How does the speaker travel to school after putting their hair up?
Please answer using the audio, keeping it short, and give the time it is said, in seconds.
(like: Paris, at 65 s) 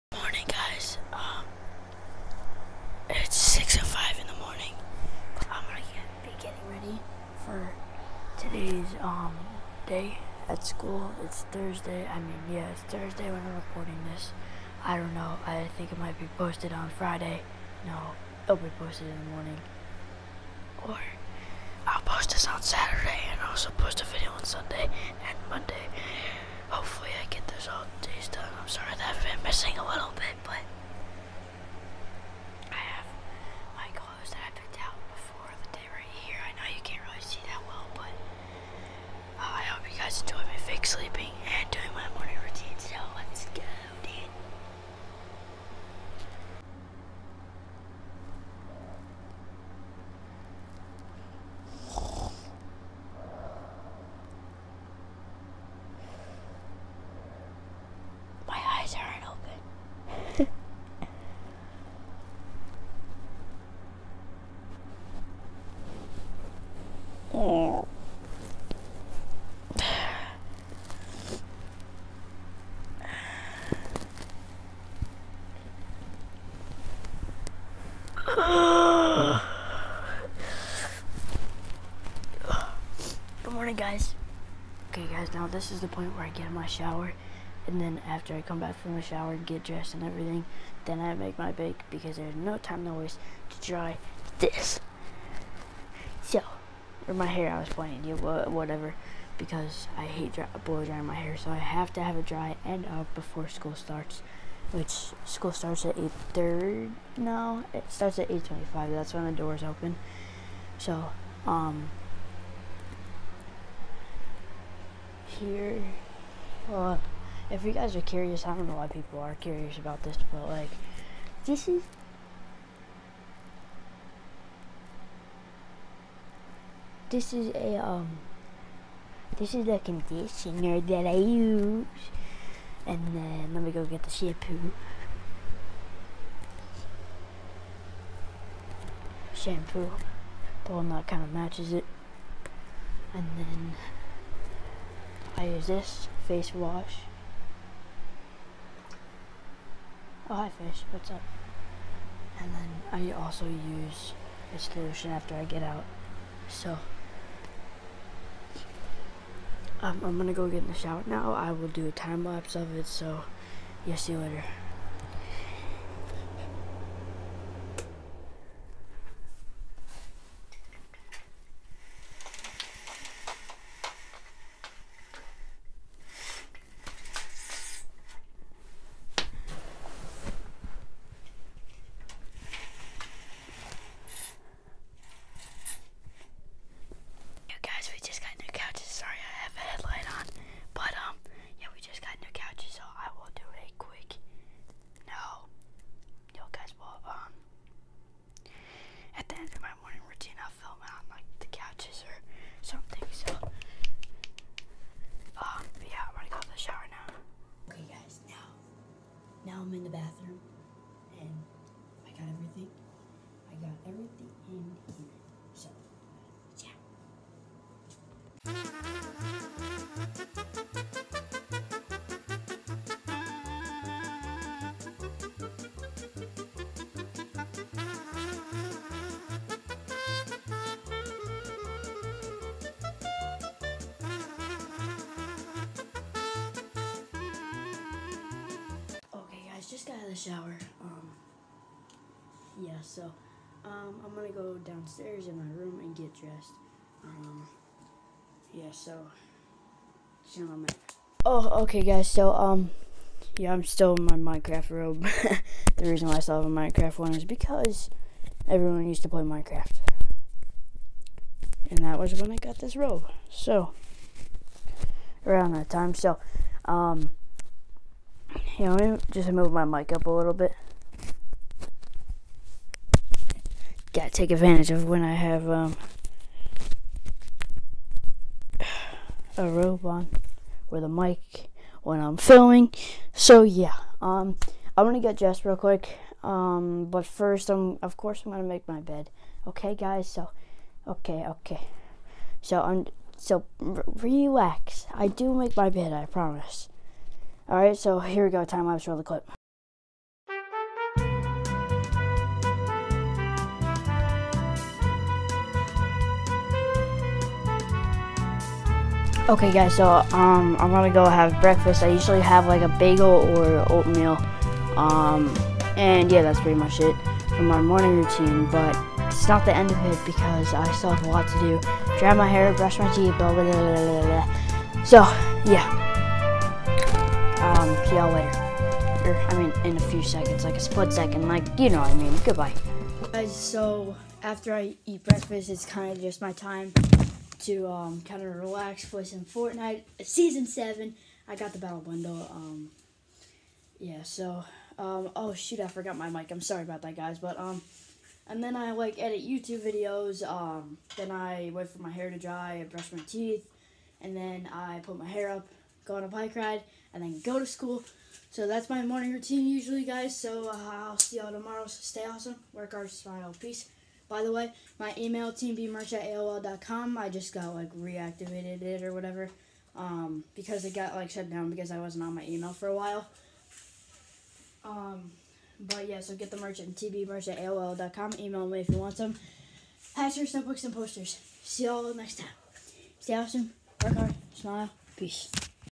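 bike ride, at 355 s.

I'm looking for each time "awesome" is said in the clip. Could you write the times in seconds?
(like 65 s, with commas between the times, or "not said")
362 s, 383 s.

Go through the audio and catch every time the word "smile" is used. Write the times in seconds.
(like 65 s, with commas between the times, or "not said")
362 s, 384 s.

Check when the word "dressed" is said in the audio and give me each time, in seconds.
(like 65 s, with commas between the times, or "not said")
89 s, 246 s, 285 s.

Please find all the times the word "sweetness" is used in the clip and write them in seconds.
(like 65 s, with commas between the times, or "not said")
not said.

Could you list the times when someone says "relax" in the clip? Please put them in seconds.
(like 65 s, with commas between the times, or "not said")
293 s, 338 s.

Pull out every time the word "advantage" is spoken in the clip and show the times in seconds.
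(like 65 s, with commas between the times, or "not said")
274 s.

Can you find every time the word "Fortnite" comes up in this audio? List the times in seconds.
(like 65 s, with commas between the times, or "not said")
339 s.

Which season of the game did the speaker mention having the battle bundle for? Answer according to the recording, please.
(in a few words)
Season 7.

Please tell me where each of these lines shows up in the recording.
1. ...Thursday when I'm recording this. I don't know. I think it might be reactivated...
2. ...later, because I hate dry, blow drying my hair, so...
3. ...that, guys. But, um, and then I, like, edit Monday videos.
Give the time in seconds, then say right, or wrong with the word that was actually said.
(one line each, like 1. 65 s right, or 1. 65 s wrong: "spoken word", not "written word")
1. 12 s wrong: "posted", not "reactivated"
2. 98 s wrong: "whatever", not "later"
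3. 346 s wrong: "YouTube", not "Monday".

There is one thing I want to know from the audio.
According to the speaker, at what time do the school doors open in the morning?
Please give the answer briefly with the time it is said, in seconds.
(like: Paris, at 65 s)
8:25, at 107 s.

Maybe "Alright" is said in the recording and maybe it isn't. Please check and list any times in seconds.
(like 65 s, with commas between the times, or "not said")
297 s.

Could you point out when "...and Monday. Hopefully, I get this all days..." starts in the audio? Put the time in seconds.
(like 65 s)
25 s.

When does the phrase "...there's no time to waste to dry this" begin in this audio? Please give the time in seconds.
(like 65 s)
92 s.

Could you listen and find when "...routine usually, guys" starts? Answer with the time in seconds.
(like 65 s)
359 s.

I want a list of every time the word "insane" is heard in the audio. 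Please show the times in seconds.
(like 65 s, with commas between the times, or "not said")
not said.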